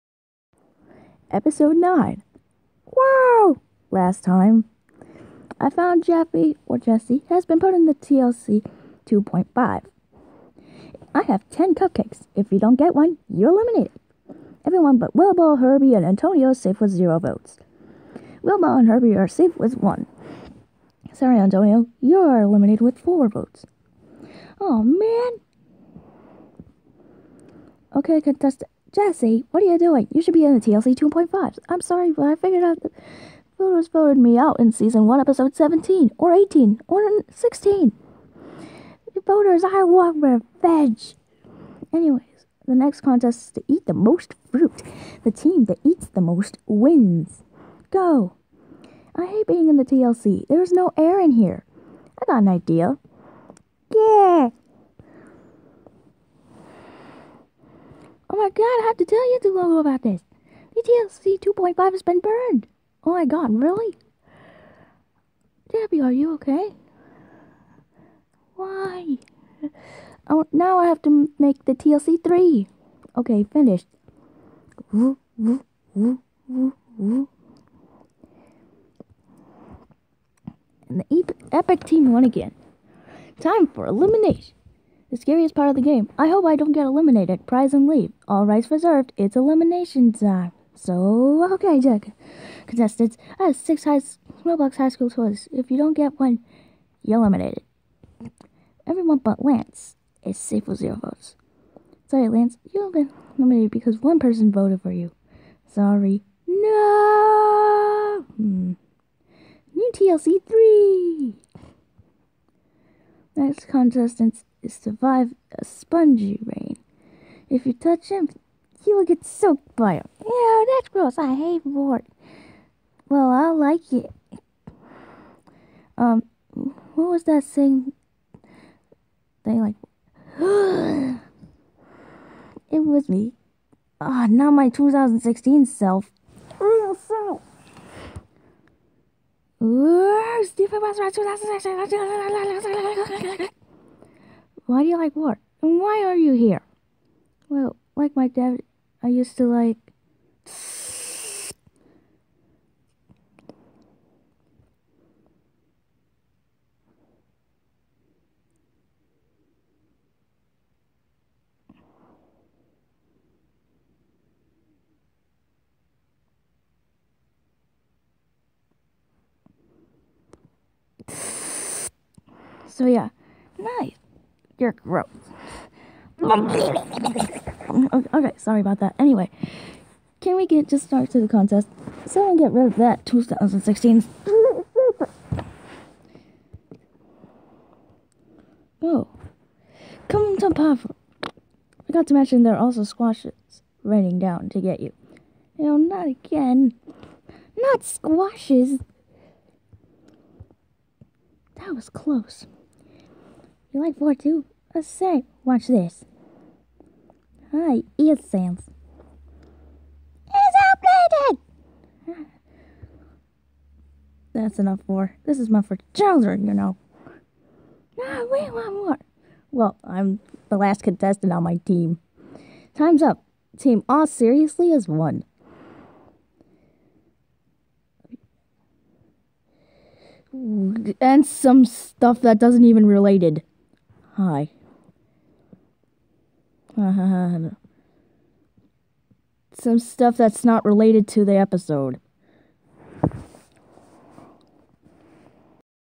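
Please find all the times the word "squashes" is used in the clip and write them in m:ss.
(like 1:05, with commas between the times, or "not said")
3:12, 3:17.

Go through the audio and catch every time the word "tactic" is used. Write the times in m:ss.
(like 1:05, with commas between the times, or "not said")
not said.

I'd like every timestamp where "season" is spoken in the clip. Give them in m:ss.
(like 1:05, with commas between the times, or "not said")
0:34.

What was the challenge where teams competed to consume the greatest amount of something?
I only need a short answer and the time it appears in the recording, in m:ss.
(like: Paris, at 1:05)
Eat the most fruit, at 0:43.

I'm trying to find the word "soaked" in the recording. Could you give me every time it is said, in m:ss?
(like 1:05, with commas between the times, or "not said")
1:59.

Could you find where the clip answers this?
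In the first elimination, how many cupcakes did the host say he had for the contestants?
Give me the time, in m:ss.
0:11.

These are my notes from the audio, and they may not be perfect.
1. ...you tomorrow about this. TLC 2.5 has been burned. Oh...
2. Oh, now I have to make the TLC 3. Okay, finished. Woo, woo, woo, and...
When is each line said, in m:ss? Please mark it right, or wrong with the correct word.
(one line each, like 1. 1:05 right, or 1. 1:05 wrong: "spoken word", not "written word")
1. 0:59 right
2. 1:10 right.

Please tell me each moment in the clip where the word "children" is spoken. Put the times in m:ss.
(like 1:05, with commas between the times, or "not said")
3:35.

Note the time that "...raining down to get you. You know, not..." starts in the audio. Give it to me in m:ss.
3:13.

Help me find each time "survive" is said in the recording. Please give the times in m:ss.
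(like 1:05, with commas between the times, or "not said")
1:54.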